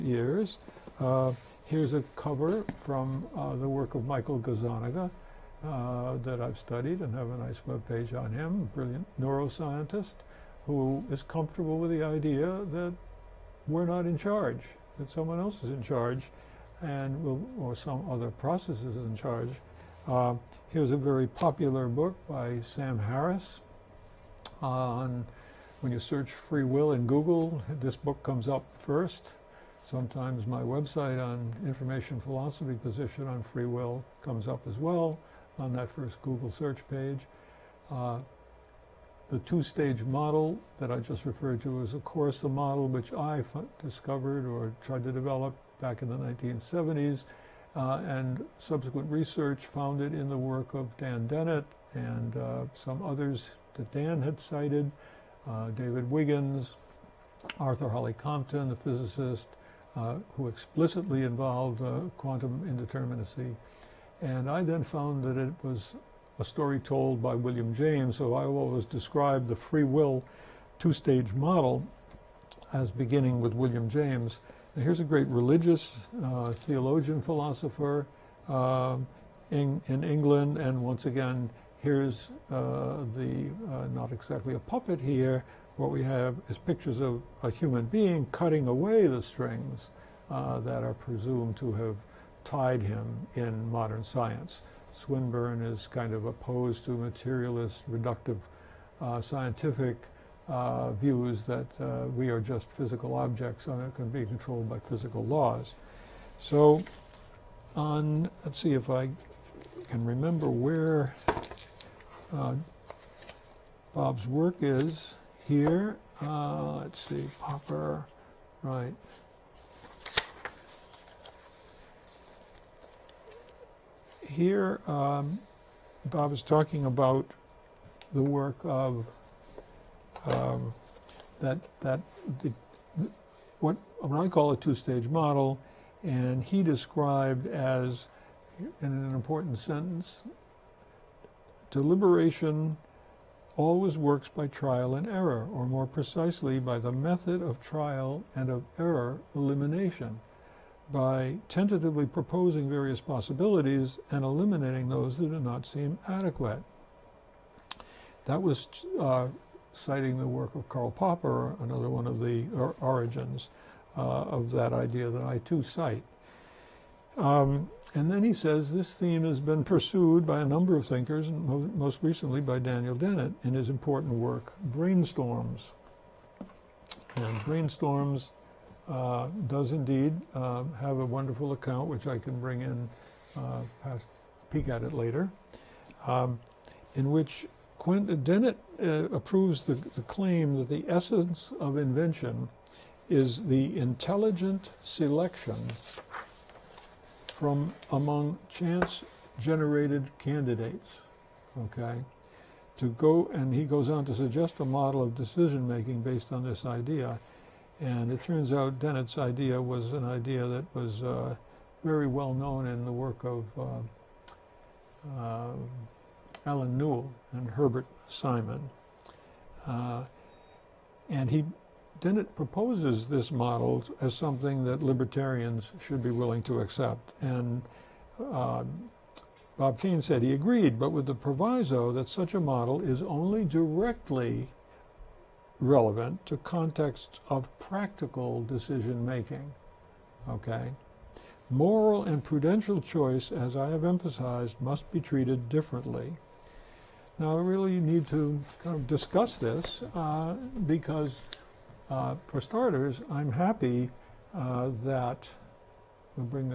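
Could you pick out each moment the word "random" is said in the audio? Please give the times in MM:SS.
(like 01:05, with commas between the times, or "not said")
not said.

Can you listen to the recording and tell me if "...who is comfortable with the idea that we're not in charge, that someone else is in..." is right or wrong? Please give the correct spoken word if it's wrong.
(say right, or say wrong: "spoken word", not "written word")
right.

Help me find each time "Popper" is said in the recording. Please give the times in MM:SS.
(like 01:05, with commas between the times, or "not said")
01:57, 02:40.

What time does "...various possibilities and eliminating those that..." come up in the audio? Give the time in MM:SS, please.
02:32.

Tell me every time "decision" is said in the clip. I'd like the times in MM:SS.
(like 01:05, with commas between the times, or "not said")
03:25, 03:58.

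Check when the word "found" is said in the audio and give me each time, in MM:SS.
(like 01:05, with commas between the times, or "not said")
00:49, 01:04.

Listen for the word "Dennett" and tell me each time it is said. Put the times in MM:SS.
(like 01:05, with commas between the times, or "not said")
00:51, 02:52, 03:08, 03:28, 03:41.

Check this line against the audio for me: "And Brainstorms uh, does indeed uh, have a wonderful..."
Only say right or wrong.
right.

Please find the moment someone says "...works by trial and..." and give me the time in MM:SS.
02:23.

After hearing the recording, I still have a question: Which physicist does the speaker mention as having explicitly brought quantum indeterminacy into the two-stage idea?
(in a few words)
Arthur Holly Compton.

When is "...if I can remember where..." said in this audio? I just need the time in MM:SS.
01:48.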